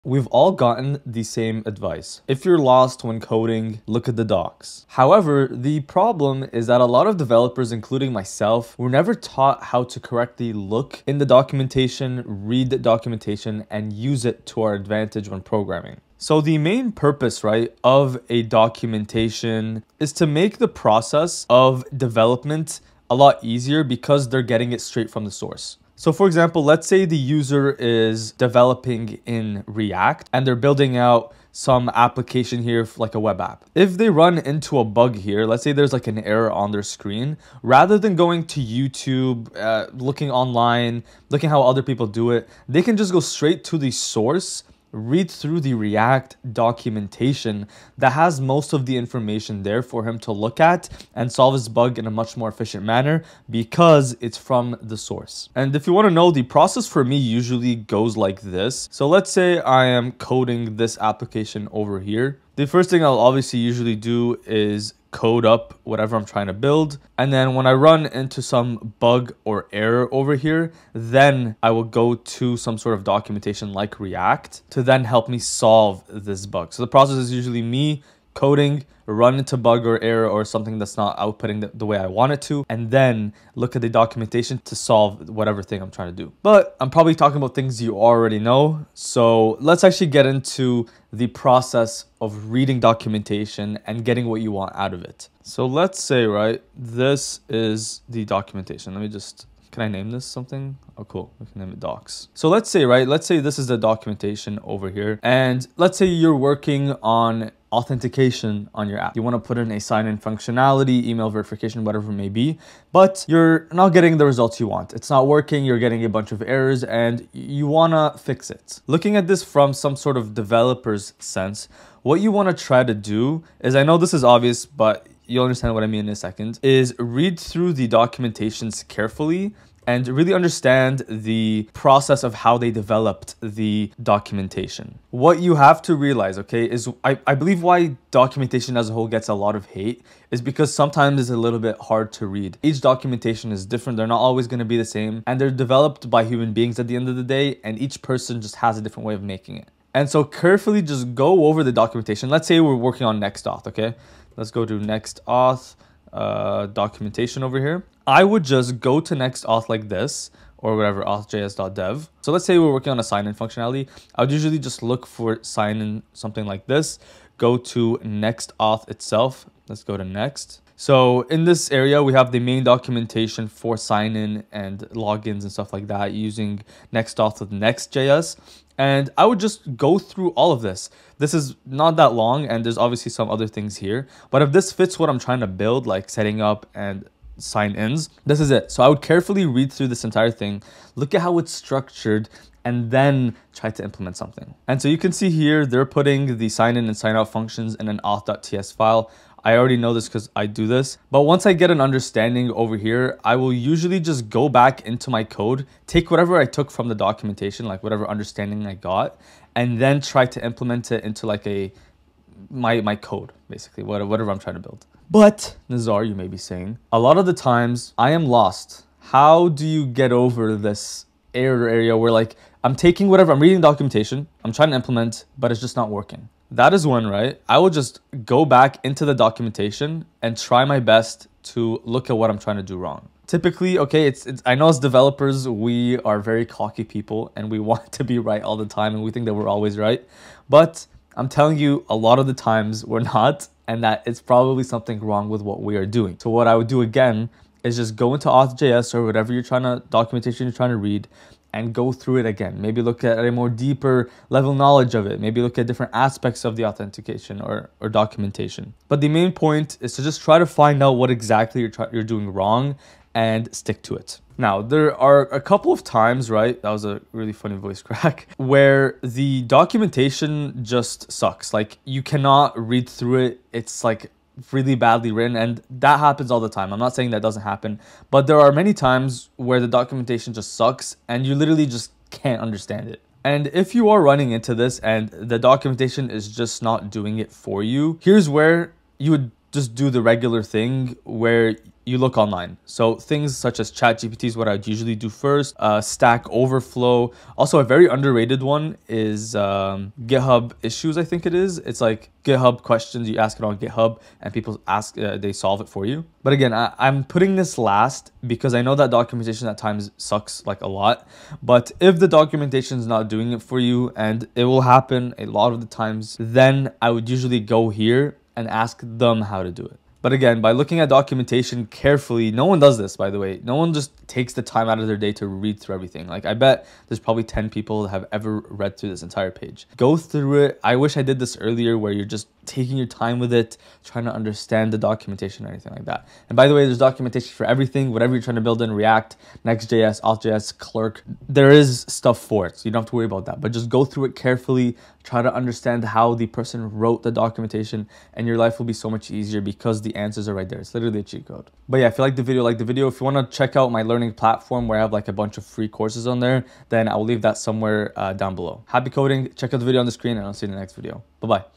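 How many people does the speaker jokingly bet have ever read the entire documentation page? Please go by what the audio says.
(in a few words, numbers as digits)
10.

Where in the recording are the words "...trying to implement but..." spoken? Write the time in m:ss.
3:44.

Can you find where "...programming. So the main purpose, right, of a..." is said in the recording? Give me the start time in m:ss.
0:15.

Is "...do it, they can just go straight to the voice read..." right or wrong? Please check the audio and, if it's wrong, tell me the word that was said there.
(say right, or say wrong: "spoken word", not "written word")
wrong: "source", not "voice".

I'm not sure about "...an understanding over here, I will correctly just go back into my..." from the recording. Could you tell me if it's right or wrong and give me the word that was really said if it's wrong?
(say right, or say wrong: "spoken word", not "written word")
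wrong: "usually", not "correctly".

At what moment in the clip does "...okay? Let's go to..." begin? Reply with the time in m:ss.
2:33.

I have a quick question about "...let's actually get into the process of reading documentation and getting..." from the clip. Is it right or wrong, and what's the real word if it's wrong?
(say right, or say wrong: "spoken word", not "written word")
right.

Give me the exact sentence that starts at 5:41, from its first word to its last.
There is stuff for it, so you don't have to worry about that.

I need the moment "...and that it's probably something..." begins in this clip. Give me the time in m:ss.
4:03.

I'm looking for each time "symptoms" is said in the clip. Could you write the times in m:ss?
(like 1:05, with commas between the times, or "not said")
not said.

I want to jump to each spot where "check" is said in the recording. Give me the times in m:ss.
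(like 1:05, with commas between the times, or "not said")
5:53, 5:59.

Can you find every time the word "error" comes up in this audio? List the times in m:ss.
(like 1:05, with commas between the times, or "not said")
0:36, 1:09, 1:20, 1:56, 3:41.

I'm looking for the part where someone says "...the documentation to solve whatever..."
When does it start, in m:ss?
1:23.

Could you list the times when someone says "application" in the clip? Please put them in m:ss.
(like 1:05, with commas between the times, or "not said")
0:31, 1:00.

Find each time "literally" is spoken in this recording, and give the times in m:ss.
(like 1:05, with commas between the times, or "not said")
4:41, 5:50.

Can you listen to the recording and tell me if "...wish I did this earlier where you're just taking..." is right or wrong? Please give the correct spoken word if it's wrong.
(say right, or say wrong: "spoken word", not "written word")
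right.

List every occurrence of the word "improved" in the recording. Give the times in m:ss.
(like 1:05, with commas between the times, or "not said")
not said.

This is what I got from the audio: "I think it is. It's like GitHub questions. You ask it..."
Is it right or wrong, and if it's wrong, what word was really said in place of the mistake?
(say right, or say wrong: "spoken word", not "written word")
right.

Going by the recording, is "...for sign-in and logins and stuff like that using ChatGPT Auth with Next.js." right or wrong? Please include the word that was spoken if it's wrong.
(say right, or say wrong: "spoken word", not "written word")
wrong: "Next", not "ChatGPT".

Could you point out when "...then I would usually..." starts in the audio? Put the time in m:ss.
5:16.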